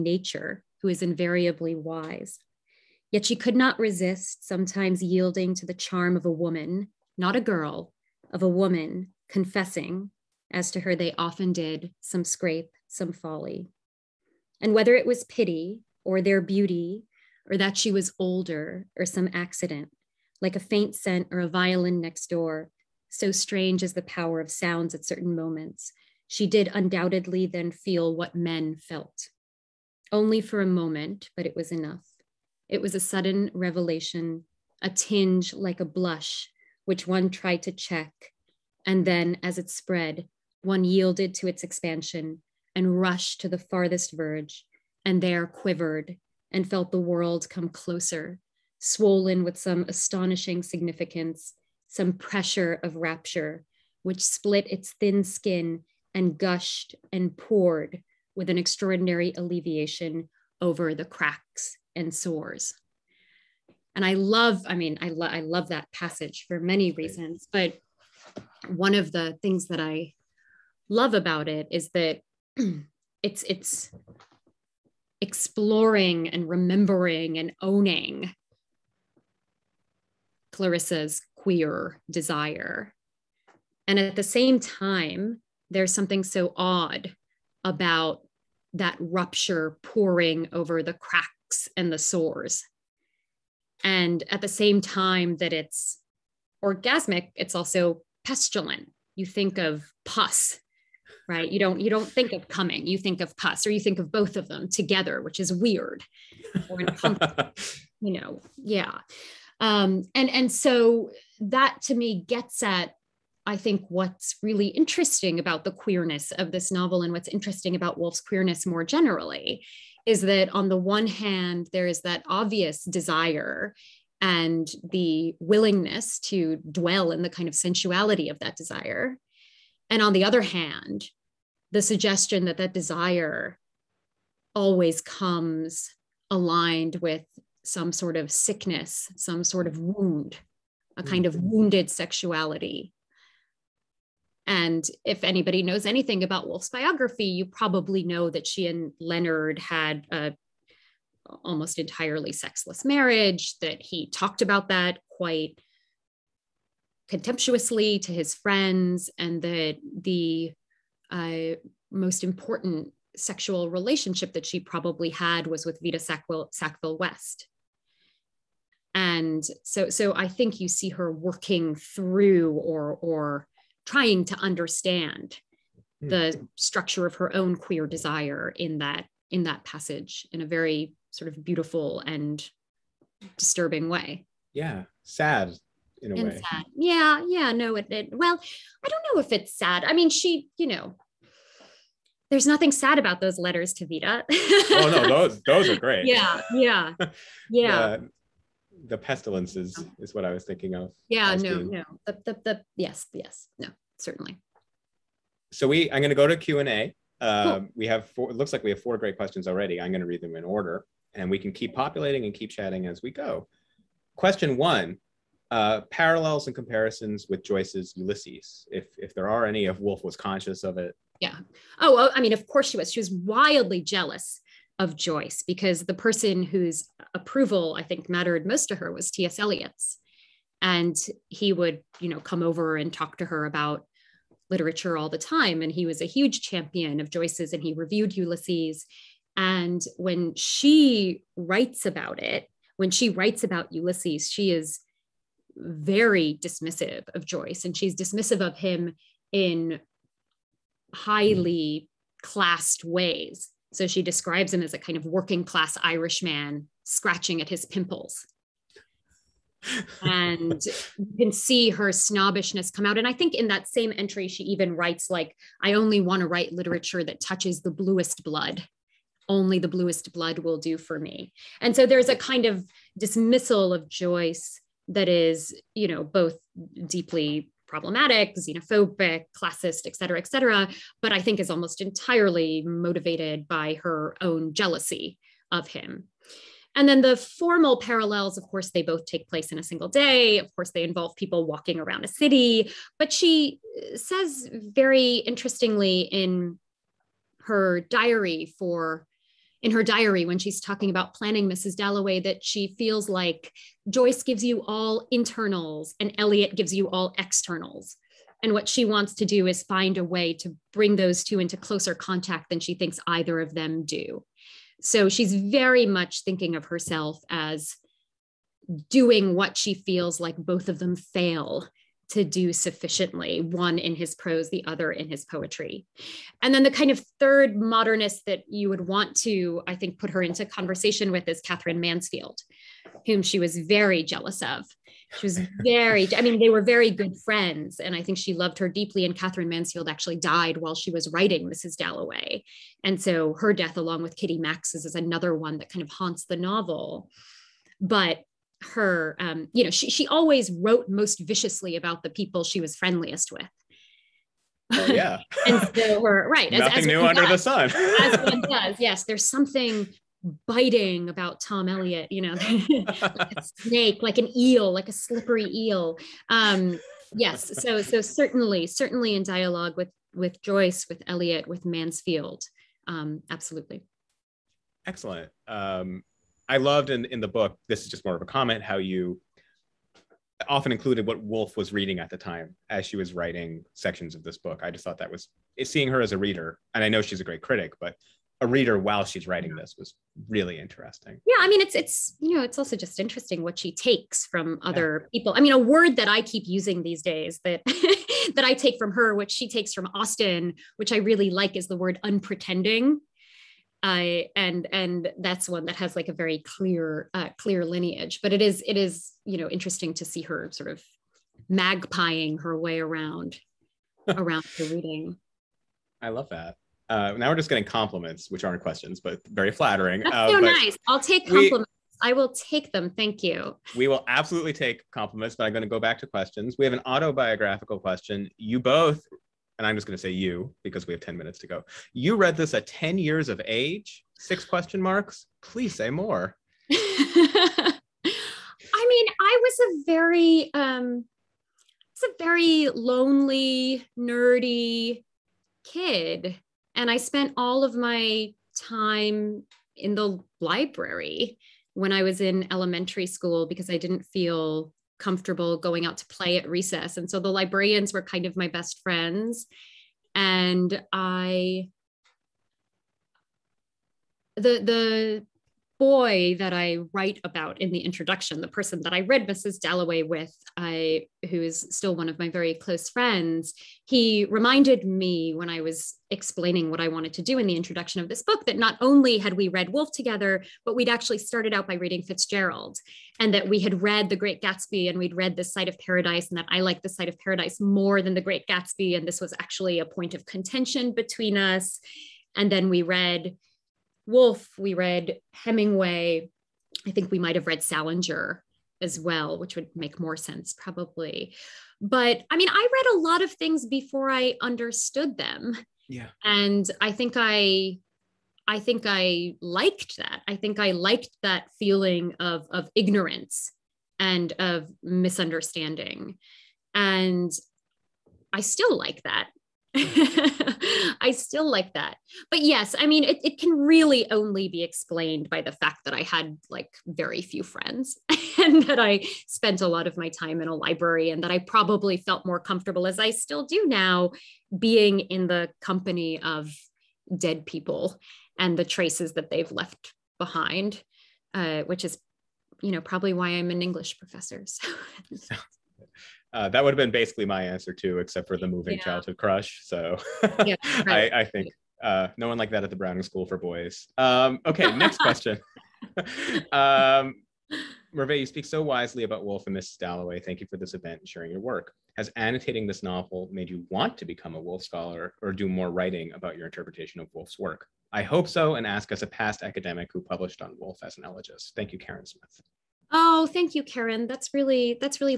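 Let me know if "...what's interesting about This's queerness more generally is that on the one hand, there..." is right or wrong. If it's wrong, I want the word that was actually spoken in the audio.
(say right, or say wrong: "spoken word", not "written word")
wrong: "Woolf", not "This".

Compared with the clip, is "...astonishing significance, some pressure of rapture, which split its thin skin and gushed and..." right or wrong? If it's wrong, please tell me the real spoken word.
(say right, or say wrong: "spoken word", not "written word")
right.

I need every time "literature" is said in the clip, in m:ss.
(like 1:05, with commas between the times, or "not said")
3:54, 4:26.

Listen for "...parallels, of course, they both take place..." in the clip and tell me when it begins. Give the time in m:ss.
4:47.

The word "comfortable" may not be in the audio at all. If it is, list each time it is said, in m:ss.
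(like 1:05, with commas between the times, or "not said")
7:34, 8:52.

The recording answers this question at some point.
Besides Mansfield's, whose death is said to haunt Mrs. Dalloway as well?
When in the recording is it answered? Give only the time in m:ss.
5:44.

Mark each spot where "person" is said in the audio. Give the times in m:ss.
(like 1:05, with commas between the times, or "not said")
3:45, 7:48.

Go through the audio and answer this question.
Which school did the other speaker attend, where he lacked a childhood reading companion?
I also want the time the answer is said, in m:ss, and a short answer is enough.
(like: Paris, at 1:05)
Browning School for Boys, at 9:12.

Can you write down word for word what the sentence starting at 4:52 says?
But she uh, says very interestingly in her diary for in her diary when she's talking about planning Mrs.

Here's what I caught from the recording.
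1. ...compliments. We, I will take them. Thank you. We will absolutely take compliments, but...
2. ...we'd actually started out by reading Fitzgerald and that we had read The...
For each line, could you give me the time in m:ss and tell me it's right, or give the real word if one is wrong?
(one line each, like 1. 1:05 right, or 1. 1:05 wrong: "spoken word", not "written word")
1. 7:01 right
2. 8:00 right.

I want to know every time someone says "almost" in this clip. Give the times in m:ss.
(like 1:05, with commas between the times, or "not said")
2:31, 4:41.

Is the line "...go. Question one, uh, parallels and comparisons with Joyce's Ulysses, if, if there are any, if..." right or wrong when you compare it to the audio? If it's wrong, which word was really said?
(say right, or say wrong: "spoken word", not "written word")
right.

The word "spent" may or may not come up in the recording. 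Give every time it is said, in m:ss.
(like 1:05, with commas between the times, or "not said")
7:26, 8:49.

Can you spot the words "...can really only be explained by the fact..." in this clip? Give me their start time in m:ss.
8:43.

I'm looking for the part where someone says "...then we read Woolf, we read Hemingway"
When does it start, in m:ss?
8:12.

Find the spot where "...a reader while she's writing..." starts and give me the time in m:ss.
6:28.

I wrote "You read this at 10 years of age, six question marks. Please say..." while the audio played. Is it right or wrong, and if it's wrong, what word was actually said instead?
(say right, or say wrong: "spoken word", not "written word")
right.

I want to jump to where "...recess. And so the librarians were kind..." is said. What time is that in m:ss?
7:36.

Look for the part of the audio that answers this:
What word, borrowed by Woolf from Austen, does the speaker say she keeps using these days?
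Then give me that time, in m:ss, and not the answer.
6:42.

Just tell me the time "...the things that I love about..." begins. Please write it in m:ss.
1:09.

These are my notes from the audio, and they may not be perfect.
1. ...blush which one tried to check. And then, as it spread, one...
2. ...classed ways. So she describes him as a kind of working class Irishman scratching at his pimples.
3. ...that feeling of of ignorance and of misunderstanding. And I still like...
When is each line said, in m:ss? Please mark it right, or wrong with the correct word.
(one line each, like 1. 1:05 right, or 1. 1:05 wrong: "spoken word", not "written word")
1. 0:35 right
2. 4:12 right
3. 8:31 right.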